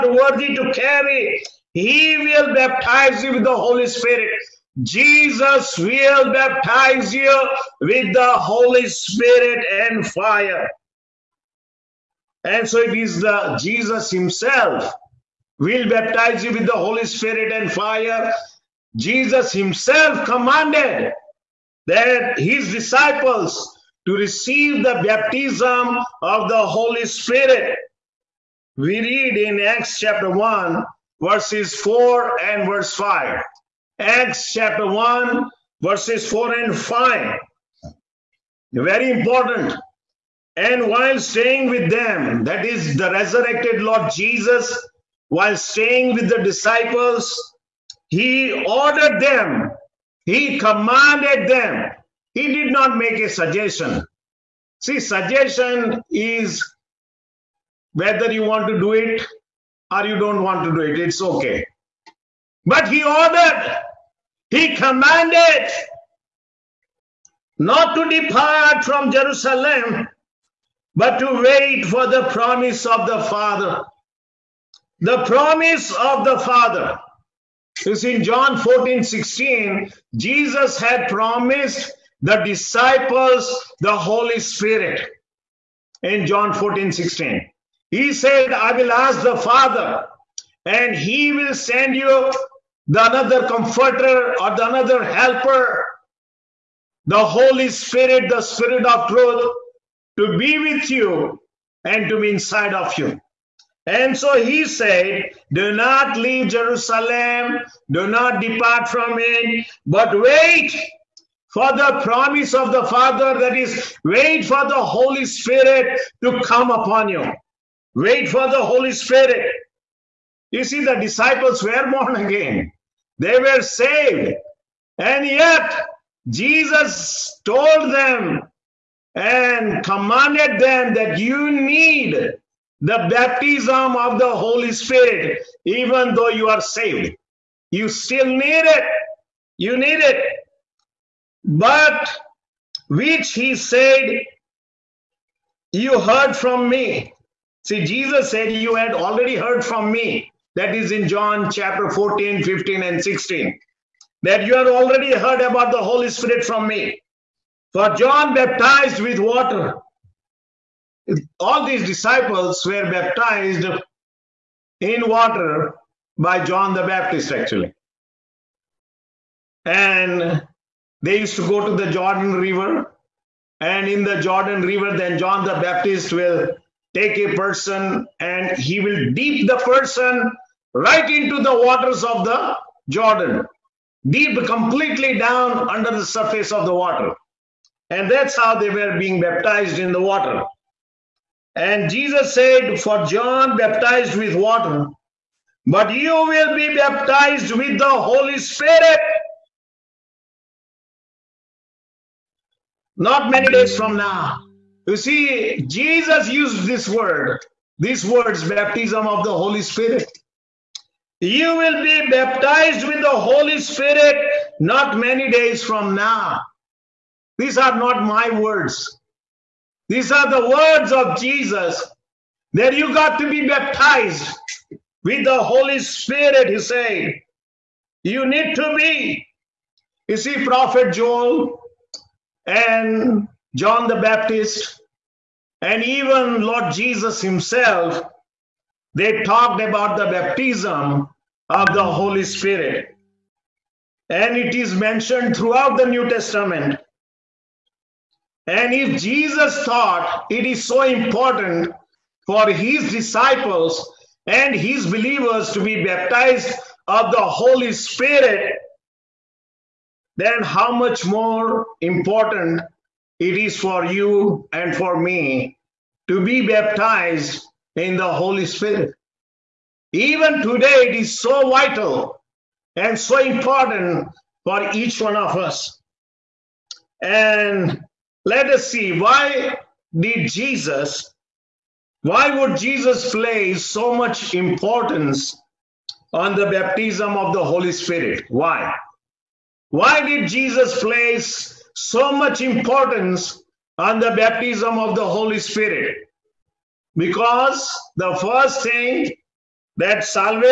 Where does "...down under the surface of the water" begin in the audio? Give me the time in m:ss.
3:05.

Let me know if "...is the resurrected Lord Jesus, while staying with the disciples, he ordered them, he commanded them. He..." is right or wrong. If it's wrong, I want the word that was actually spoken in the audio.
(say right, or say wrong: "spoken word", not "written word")
right.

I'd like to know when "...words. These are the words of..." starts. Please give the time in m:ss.
3:38.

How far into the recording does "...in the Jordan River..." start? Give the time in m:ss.
2:53.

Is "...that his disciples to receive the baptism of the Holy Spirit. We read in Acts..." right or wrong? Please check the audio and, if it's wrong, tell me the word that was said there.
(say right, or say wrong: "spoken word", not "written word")
right.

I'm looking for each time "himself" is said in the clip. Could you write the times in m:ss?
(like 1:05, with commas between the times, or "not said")
0:14, 0:19, 3:57.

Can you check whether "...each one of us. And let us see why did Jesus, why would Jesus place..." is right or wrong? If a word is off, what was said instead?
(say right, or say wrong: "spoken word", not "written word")
right.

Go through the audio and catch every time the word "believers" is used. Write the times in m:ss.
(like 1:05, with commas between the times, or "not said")
4:14.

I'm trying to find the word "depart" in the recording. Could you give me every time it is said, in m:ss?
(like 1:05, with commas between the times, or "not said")
1:08, 1:48.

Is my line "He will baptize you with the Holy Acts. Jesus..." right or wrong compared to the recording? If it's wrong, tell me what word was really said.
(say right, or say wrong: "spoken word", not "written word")
wrong: "Spirit", not "Acts".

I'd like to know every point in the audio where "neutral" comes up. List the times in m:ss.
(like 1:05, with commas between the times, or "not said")
not said.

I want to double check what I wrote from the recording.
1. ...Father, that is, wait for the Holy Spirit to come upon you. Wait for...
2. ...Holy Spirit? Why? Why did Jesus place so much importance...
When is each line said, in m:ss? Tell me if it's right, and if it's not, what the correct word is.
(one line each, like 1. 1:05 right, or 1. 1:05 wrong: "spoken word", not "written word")
1. 1:52 right
2. 4:47 right.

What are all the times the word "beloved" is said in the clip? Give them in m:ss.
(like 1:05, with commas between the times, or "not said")
not said.